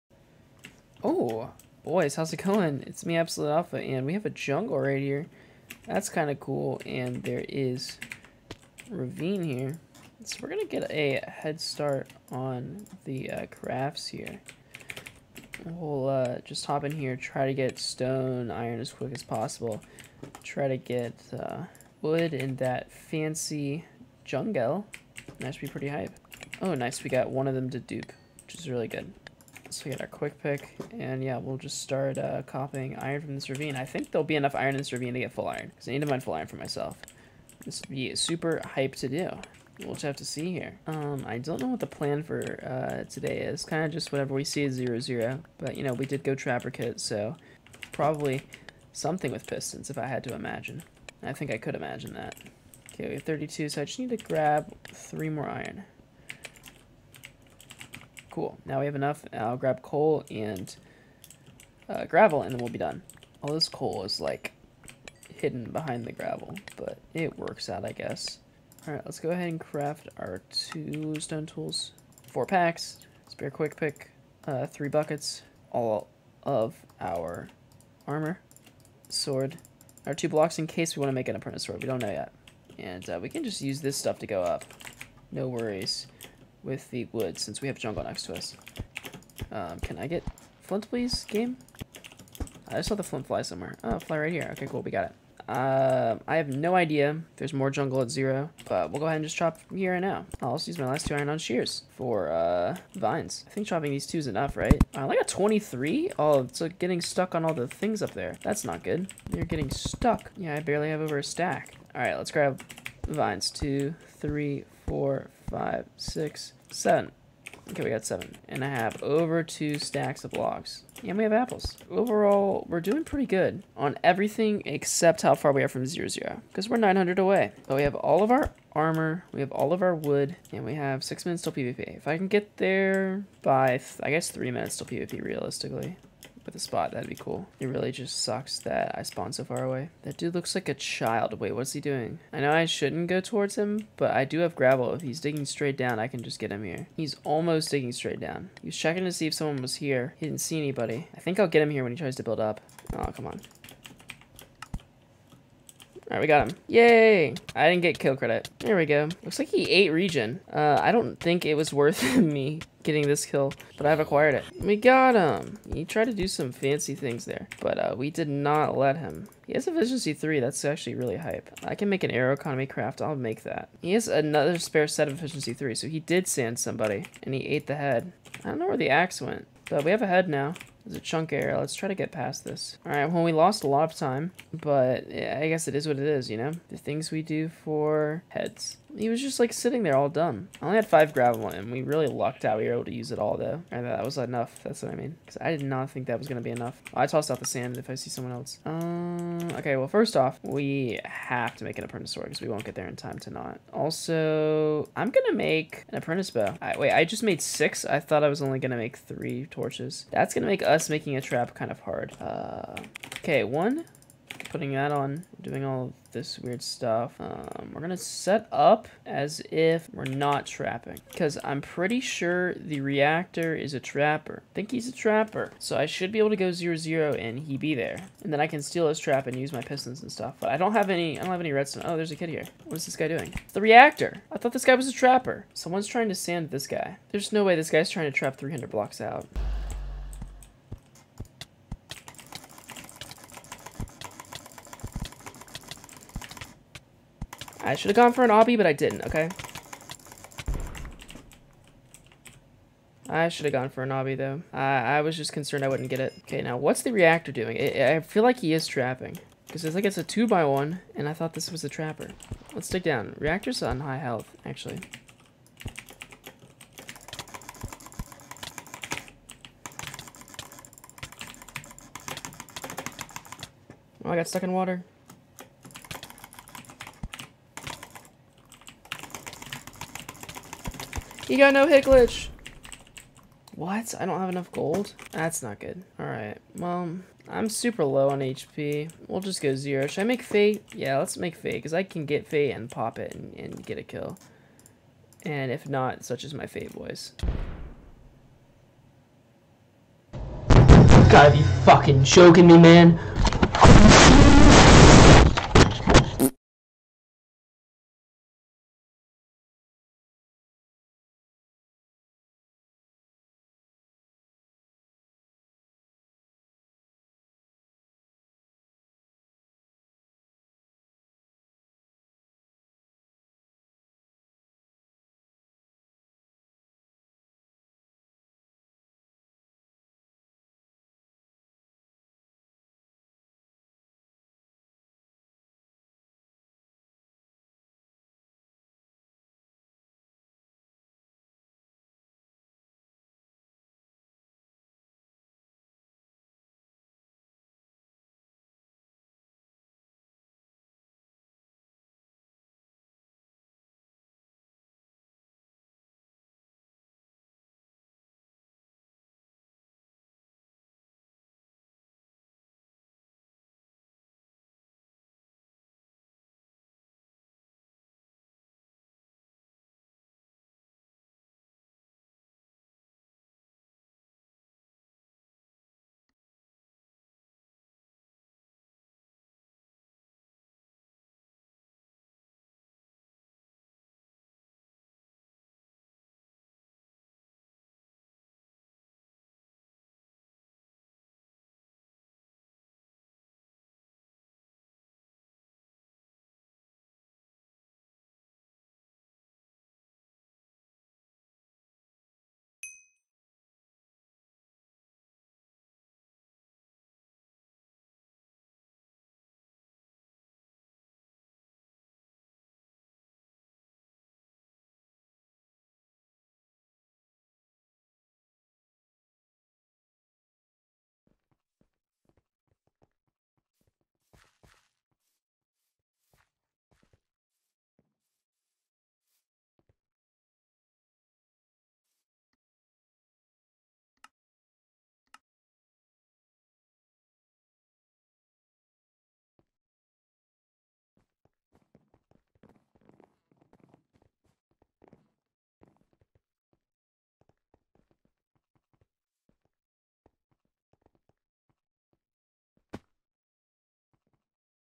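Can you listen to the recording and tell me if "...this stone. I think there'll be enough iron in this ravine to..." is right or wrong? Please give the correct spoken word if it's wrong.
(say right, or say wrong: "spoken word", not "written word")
wrong: "ravine", not "stone".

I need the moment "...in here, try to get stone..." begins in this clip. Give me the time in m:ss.
0:16.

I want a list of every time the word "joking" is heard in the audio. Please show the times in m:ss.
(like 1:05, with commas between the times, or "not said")
5:02.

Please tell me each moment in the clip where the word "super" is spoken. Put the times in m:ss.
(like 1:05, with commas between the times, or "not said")
0:38, 4:47.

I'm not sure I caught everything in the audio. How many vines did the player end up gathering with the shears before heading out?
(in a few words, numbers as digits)
7.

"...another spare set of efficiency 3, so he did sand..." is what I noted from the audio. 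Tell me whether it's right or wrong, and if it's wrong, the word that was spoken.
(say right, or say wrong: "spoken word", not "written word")
right.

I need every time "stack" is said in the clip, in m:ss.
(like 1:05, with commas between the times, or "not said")
1:51, 1:59.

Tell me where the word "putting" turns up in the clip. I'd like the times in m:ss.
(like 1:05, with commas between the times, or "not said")
3:34.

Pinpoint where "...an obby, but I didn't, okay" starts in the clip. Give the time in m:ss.
4:08.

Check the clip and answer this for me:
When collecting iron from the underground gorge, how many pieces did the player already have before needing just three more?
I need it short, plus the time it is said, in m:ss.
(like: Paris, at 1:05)
32, at 0:53.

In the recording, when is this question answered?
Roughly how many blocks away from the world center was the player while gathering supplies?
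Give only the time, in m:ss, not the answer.
2:06.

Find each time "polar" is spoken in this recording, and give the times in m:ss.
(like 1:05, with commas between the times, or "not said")
not said.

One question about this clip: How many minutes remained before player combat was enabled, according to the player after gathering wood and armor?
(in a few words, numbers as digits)
6.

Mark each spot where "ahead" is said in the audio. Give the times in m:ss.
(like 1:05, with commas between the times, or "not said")
1:09, 1:39.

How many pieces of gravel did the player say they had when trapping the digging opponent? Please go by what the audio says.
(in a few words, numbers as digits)
5.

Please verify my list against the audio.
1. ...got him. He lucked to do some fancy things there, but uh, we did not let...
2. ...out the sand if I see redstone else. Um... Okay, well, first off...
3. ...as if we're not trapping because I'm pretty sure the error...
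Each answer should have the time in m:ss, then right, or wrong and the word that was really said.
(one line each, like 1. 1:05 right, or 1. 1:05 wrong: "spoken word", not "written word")
1. 2:44 wrong: "tried", not "lucked"
2. 3:17 wrong: "someone", not "redstone"
3. 3:39 wrong: "reactor", not "error".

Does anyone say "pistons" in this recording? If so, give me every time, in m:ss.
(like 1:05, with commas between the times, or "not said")
0:49, 3:49.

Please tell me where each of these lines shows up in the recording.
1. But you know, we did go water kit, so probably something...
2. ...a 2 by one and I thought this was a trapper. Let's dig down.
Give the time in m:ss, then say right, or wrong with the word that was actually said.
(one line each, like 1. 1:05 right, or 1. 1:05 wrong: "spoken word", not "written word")
1. 0:45 wrong: "trapper", not "water"
2. 4:19 right.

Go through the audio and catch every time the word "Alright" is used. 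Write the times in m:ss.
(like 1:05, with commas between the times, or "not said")
1:08, 4:45.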